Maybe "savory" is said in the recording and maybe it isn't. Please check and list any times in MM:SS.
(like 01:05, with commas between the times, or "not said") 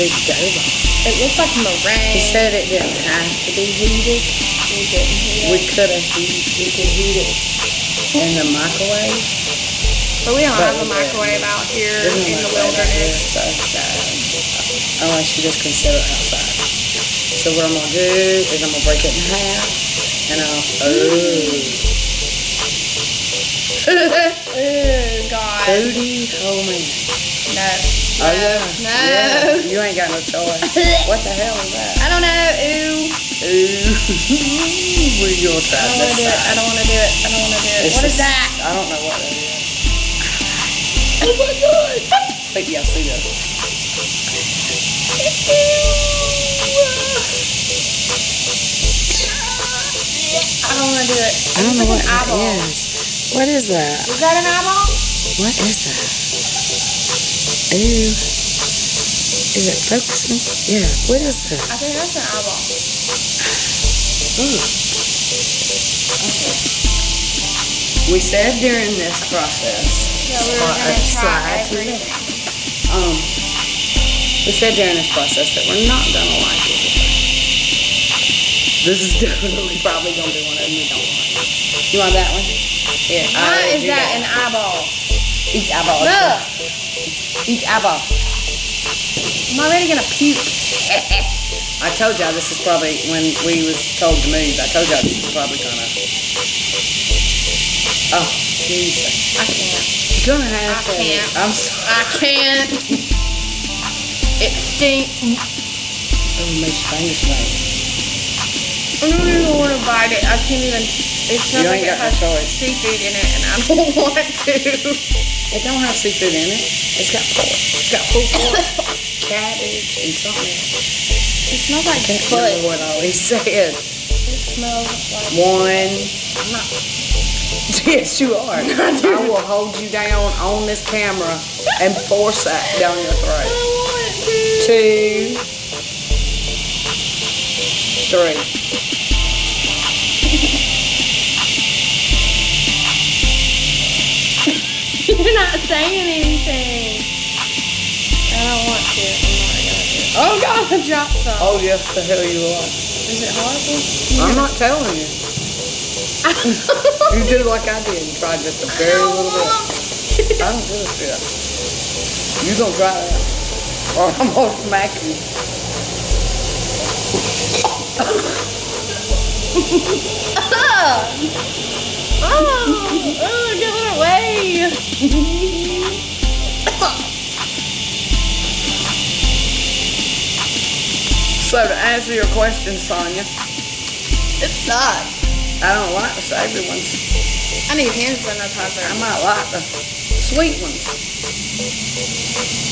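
03:06.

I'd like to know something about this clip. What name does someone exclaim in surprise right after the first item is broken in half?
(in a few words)
Cody Coleman.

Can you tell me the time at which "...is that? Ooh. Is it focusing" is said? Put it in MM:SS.
00:55.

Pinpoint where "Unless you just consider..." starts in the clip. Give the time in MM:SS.
00:15.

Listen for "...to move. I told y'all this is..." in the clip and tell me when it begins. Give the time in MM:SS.
01:34.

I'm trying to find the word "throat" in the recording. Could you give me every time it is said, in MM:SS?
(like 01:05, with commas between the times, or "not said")
02:13.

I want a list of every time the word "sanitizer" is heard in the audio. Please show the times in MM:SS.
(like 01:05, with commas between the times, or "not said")
03:08.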